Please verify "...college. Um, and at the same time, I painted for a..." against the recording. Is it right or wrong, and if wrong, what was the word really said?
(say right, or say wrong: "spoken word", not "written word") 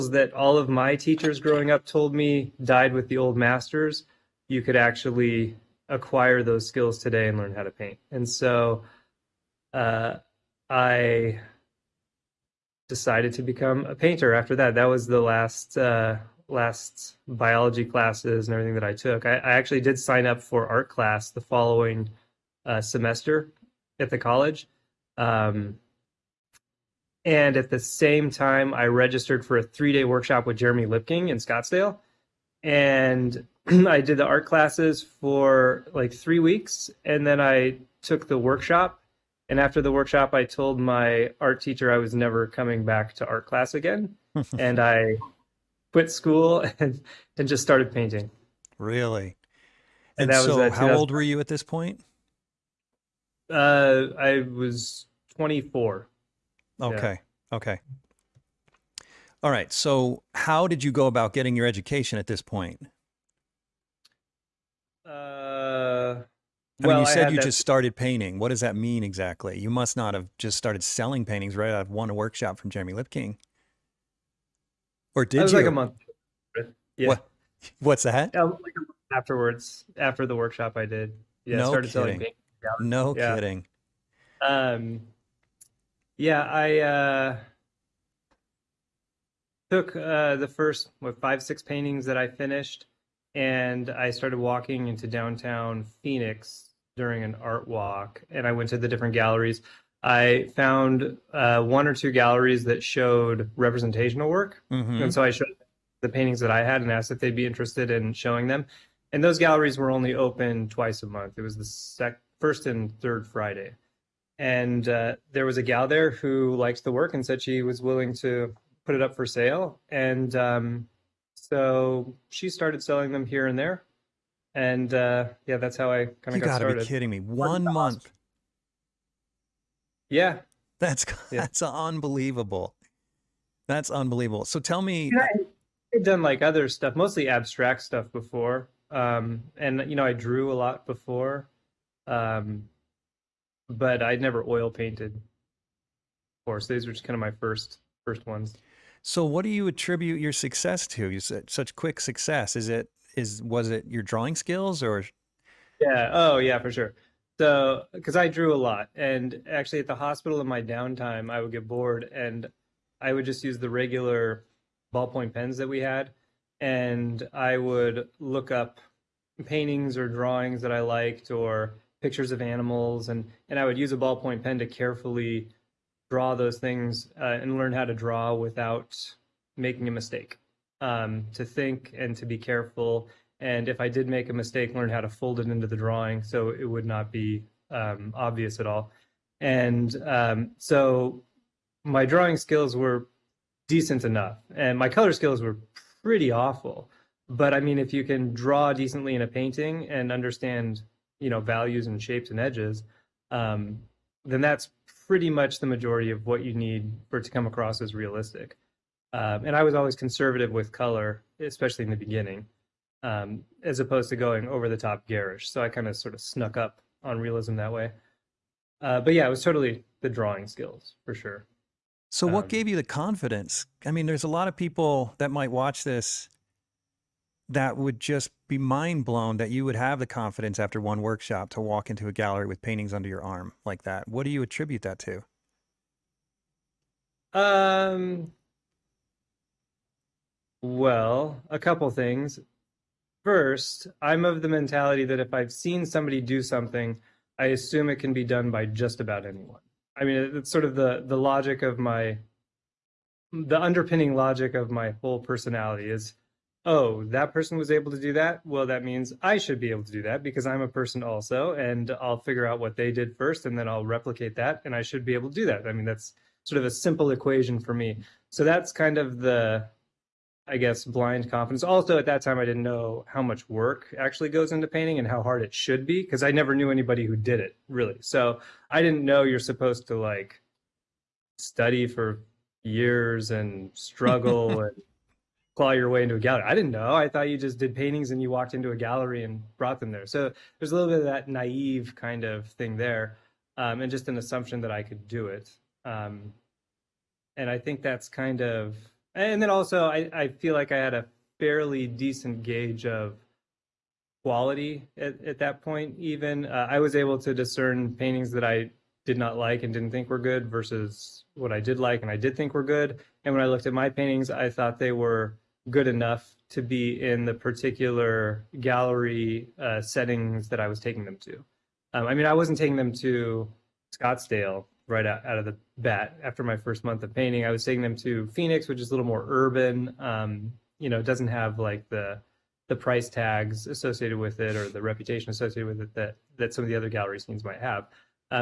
wrong: "registered", not "painted".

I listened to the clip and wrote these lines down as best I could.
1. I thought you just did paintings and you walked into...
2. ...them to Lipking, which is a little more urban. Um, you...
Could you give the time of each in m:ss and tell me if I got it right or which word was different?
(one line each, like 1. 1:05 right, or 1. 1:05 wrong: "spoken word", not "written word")
1. 4:46 right
2. 5:27 wrong: "Phoenix", not "Lipking".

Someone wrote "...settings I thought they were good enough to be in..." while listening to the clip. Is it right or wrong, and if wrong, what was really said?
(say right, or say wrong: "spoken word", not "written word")
wrong: "paintings", not "settings".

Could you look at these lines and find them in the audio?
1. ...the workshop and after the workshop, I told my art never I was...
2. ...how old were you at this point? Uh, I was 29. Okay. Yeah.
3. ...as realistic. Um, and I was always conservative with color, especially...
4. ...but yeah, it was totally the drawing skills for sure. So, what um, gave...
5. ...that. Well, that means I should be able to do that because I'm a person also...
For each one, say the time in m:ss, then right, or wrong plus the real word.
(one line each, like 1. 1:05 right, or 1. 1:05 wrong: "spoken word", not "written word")
1. 0:38 wrong: "teacher", not "never"
2. 0:50 wrong: "24", not "29"
3. 3:27 right
4. 3:38 right
5. 4:18 right.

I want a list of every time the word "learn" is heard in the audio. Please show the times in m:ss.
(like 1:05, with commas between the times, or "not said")
0:07, 2:57, 3:04.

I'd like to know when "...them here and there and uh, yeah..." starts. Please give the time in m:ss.
2:03.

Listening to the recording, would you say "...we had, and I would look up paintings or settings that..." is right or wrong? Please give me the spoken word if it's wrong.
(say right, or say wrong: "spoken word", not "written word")
wrong: "drawings", not "settings".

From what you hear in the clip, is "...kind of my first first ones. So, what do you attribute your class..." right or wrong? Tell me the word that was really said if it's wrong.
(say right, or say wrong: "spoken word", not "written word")
wrong: "success", not "class".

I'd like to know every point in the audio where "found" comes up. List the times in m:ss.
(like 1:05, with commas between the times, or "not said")
1:40.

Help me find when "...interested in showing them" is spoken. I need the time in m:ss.
1:47.